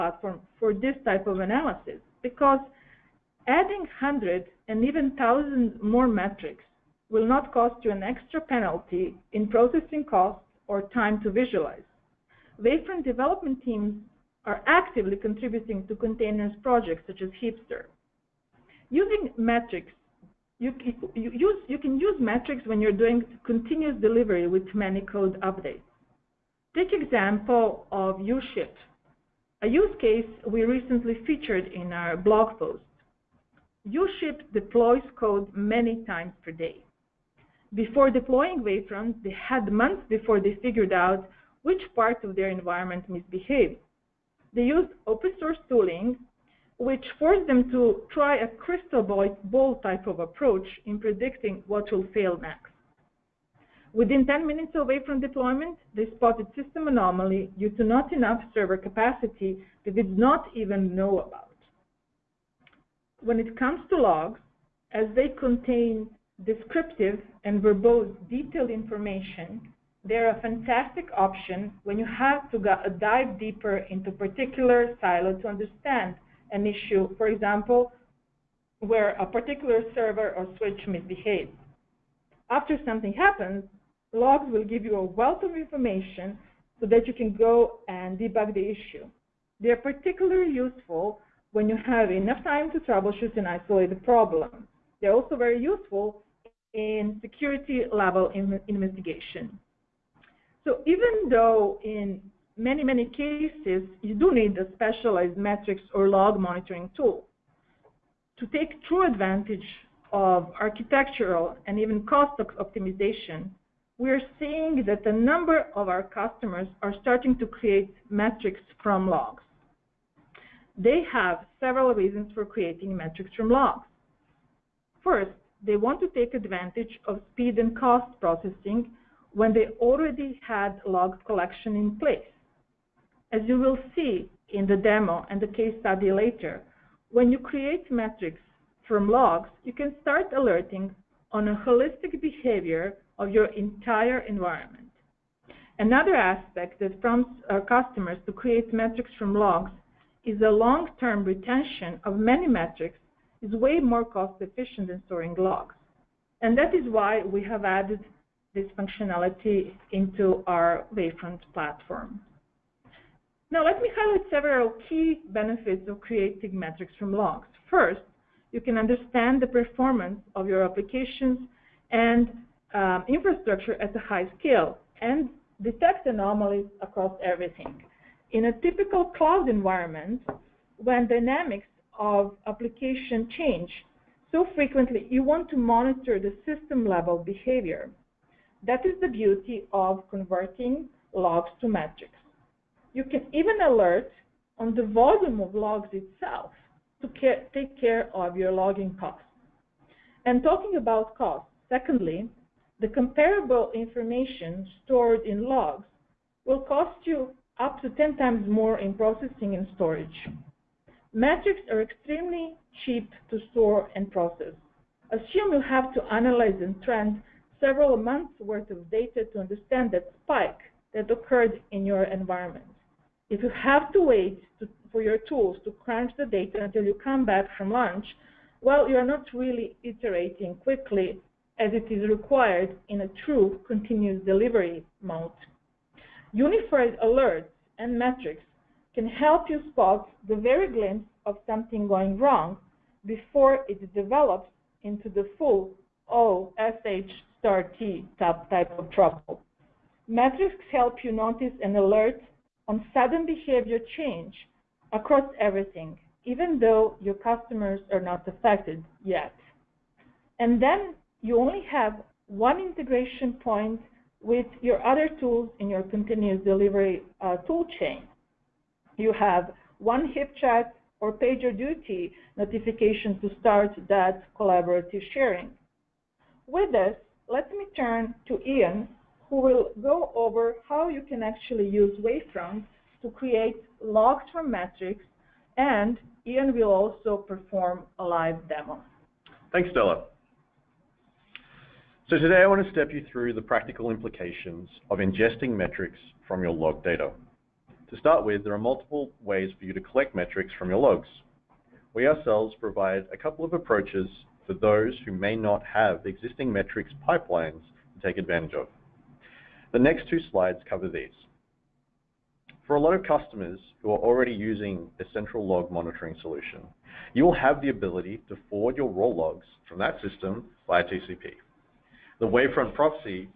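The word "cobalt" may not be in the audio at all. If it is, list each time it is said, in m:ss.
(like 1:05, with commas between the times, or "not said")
not said.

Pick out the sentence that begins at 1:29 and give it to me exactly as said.
They're particularly useful when you have enough time to troubleshoot and isolate the problem.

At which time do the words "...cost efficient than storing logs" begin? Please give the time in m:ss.
2:34.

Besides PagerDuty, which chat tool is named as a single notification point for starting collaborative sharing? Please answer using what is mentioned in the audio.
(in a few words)
HipChat.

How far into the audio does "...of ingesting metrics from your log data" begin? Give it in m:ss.
4:54.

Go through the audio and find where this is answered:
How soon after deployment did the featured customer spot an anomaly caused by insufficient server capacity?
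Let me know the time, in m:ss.
0:54.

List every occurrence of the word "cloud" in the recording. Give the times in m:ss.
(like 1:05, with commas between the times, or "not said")
2:59.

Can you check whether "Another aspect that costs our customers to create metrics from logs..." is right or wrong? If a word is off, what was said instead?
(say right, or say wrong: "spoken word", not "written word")
wrong: "prompts", not "costs".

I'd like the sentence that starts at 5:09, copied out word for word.
The next two slides cover these.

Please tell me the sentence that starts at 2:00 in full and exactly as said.
They have several reasons for creating metrics from logs.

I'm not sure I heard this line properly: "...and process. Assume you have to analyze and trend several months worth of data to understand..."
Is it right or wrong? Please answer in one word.
right.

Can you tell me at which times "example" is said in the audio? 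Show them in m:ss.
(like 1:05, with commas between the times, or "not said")
0:26, 1:17.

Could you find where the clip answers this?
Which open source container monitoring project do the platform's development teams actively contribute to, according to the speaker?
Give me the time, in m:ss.
0:17.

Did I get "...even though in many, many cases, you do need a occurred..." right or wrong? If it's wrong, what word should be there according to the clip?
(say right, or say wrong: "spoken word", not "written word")
wrong: "specialized", not "occurred".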